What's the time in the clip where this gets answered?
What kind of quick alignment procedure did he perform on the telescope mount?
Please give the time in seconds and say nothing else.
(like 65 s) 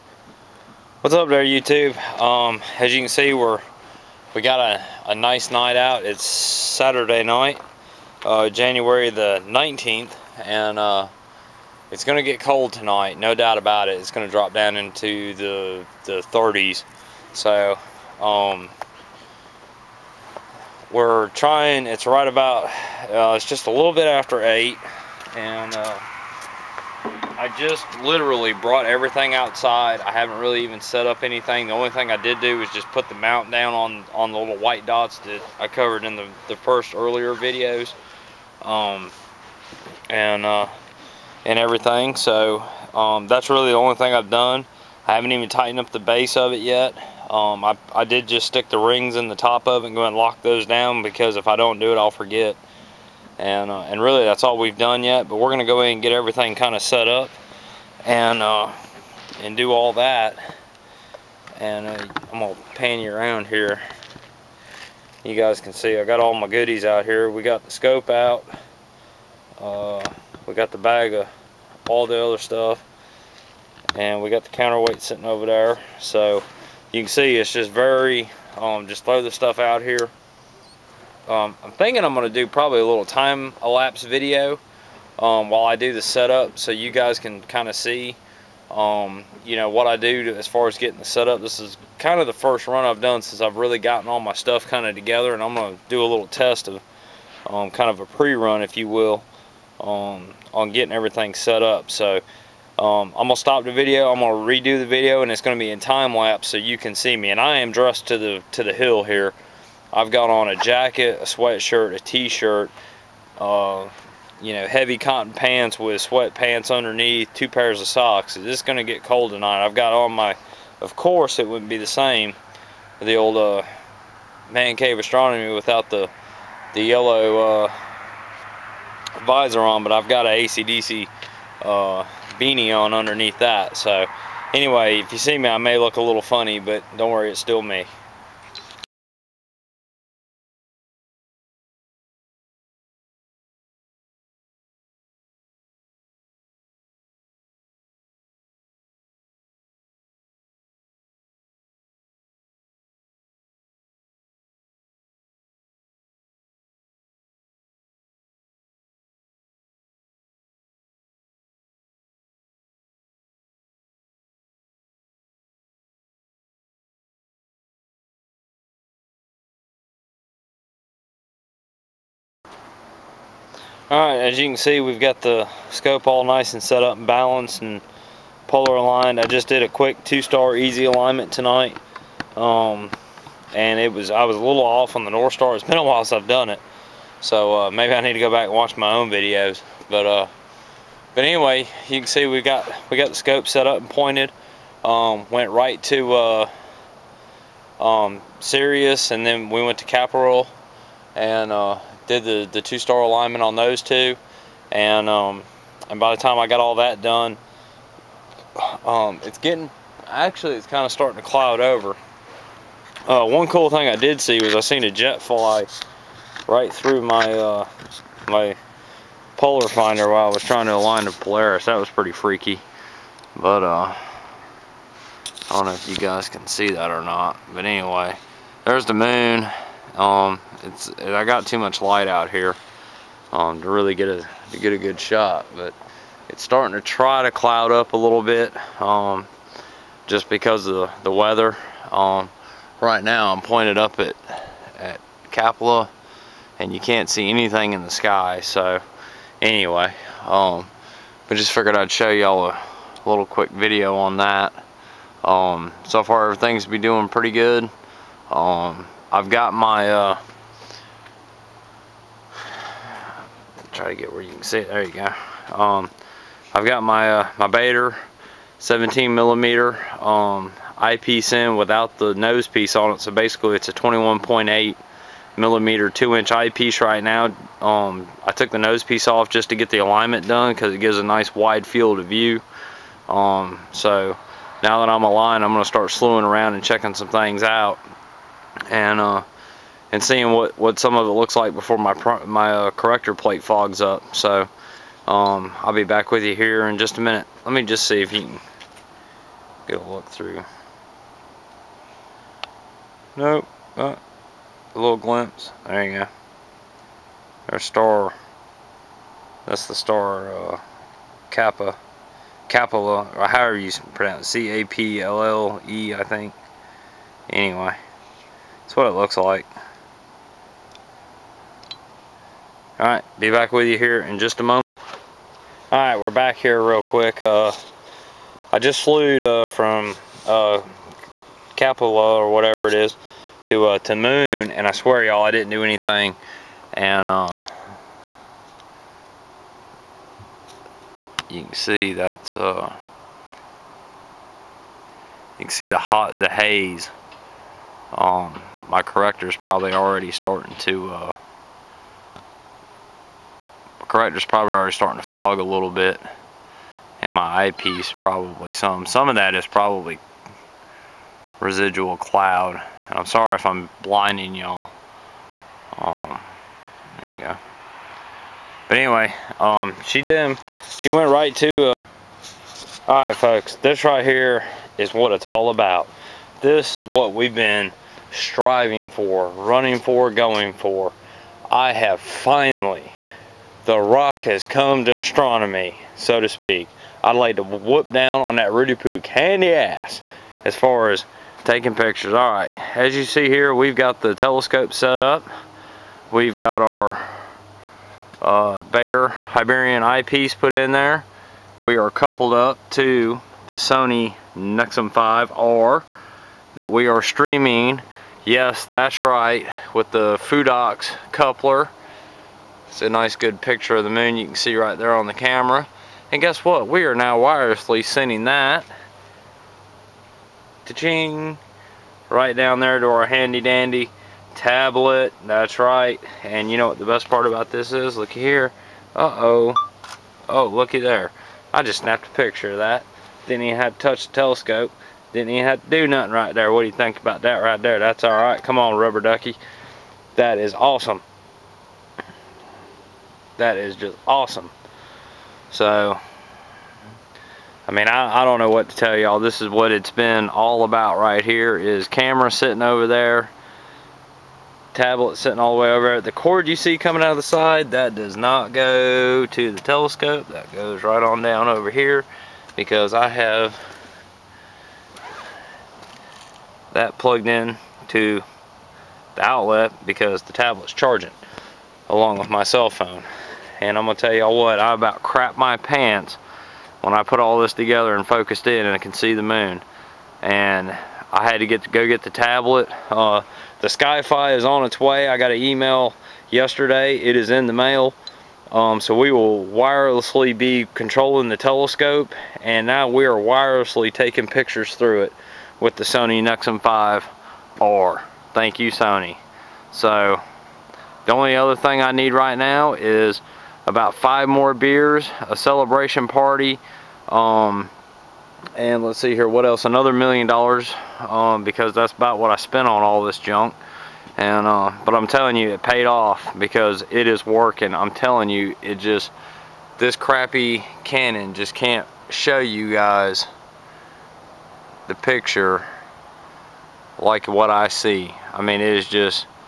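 180 s.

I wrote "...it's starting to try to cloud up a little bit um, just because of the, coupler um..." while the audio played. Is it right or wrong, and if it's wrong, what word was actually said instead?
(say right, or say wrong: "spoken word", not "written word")
wrong: "weather", not "coupler".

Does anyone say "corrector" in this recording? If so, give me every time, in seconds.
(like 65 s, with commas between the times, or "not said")
292 s, 353 s.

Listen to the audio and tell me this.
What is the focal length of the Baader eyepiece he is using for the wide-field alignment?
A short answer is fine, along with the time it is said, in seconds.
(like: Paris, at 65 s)
17 millimeter, at 268 s.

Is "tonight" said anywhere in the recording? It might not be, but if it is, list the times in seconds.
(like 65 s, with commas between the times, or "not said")
12 s, 119 s, 181 s.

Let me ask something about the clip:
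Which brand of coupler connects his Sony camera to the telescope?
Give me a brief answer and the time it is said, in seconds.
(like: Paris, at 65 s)
Fotodiox, at 410 s.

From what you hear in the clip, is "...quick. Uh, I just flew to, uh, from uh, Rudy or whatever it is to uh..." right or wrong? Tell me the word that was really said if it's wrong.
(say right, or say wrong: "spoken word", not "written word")
wrong: "Capua", not "Rudy".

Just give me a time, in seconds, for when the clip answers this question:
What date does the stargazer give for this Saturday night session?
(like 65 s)
8 s.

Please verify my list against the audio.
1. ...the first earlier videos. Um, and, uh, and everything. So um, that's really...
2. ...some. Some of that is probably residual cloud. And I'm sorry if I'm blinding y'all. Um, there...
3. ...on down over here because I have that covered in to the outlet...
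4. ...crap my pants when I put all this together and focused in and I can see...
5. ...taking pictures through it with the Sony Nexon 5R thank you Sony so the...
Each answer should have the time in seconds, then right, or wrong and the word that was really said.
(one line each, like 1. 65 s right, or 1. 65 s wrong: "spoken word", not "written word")
1. 36 s right
2. 358 s right
3. 461 s wrong: "plugged", not "covered"
4. 475 s right
5. 493 s right.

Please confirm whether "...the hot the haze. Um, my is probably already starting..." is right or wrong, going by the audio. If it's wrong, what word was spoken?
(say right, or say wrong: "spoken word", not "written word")
right.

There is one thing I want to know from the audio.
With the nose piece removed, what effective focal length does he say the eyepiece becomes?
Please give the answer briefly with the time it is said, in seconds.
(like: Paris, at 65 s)
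21.8 millimeter, at 273 s.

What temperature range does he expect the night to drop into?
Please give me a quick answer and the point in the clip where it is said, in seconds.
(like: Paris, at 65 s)
the 30s, at 16 s.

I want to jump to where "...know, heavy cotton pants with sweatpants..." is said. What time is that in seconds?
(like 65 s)
114 s.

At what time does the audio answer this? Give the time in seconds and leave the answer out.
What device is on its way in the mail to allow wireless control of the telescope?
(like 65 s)
483 s.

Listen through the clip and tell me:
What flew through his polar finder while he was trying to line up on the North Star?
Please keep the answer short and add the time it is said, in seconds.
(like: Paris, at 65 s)
a jet, at 214 s.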